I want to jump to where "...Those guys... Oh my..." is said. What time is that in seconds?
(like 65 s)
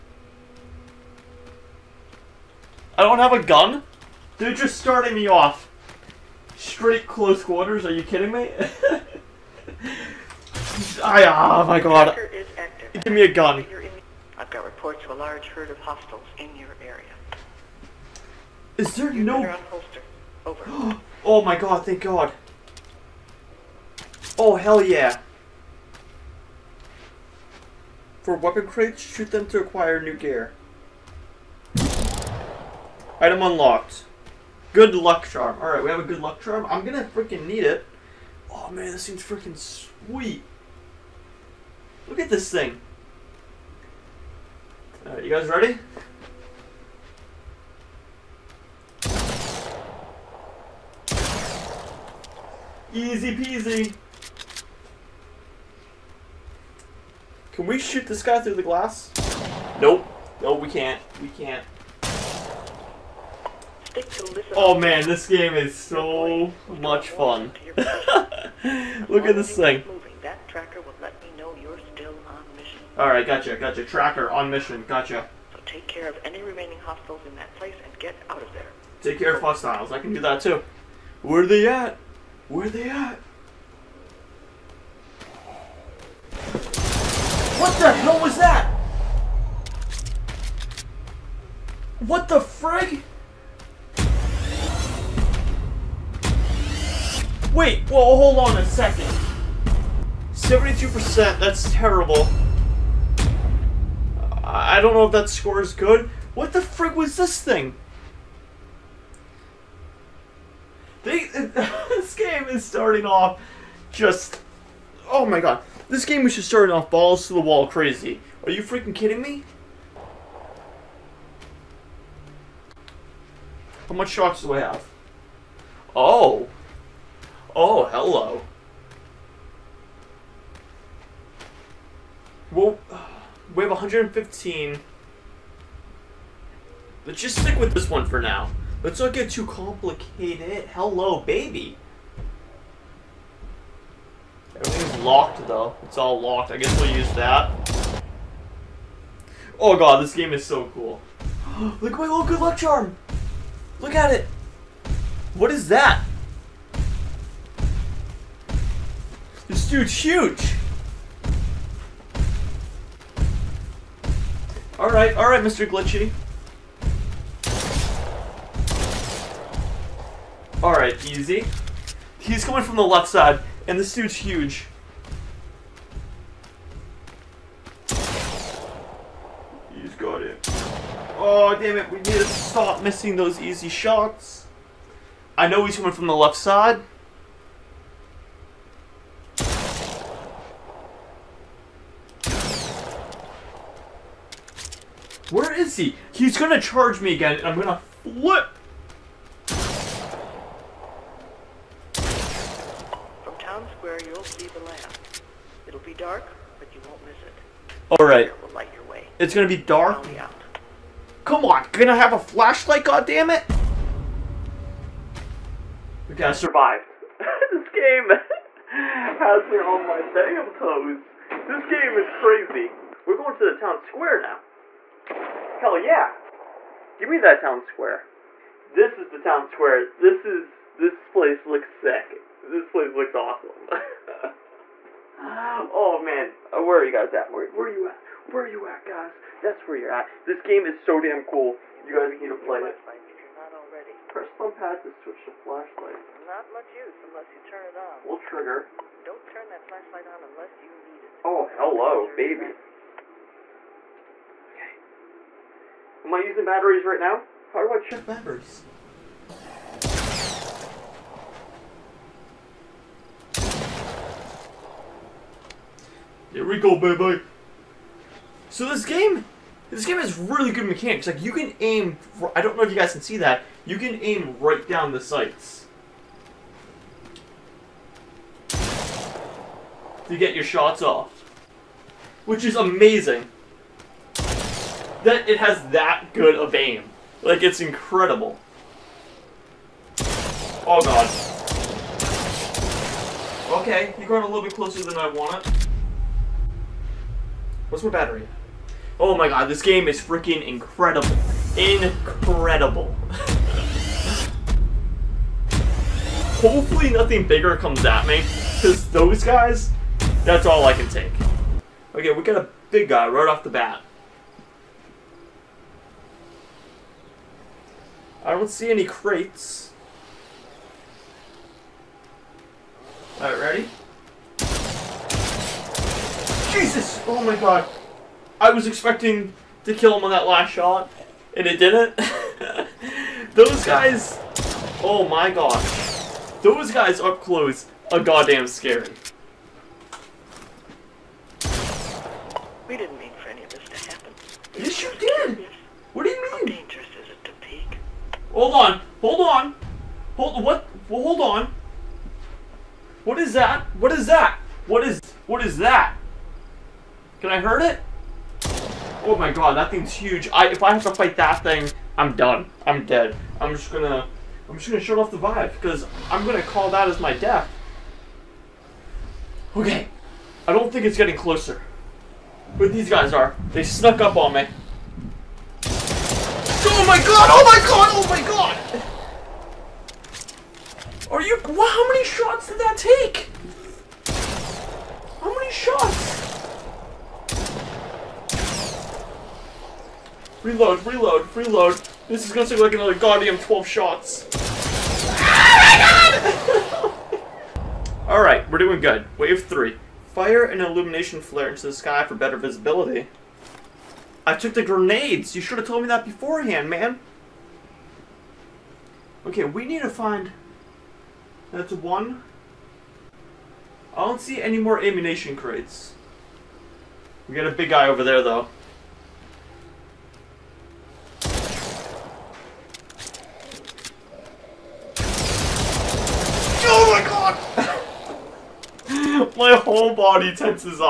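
333 s.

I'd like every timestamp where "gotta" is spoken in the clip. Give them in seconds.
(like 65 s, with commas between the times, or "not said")
216 s.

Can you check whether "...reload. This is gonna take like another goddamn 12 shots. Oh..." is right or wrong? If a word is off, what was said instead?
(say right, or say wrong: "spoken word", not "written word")
right.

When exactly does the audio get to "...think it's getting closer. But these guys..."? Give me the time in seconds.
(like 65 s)
370 s.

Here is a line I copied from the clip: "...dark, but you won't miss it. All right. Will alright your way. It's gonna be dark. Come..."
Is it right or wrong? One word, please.
wrong.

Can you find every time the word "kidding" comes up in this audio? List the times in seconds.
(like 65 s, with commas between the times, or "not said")
8 s, 118 s.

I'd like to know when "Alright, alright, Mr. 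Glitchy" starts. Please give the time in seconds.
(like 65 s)
164 s.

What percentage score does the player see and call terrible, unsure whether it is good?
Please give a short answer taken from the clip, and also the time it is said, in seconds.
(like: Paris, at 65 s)
72%, at 100 s.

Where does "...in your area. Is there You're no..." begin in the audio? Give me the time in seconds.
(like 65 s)
16 s.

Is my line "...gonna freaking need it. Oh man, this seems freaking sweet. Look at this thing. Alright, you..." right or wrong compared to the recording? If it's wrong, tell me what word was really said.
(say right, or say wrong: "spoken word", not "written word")
right.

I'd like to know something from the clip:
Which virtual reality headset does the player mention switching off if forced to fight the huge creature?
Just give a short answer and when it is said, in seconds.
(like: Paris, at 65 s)
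Vive, at 365 s.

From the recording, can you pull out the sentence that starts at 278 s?
To get your shots off, which is amazing that it has that good of aim.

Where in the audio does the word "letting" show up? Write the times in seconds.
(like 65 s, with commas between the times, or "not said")
not said.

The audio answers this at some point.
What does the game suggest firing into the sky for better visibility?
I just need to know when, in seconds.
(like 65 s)
400 s.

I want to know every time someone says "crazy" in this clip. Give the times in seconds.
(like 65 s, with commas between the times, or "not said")
117 s, 222 s.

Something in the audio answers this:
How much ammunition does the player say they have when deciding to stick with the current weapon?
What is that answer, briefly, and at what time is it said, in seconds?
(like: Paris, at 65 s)
115, at 133 s.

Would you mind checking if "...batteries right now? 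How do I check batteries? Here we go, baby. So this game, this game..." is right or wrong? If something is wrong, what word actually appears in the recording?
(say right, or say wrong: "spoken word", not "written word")
right.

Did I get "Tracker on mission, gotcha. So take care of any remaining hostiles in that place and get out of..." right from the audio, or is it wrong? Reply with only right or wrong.
right.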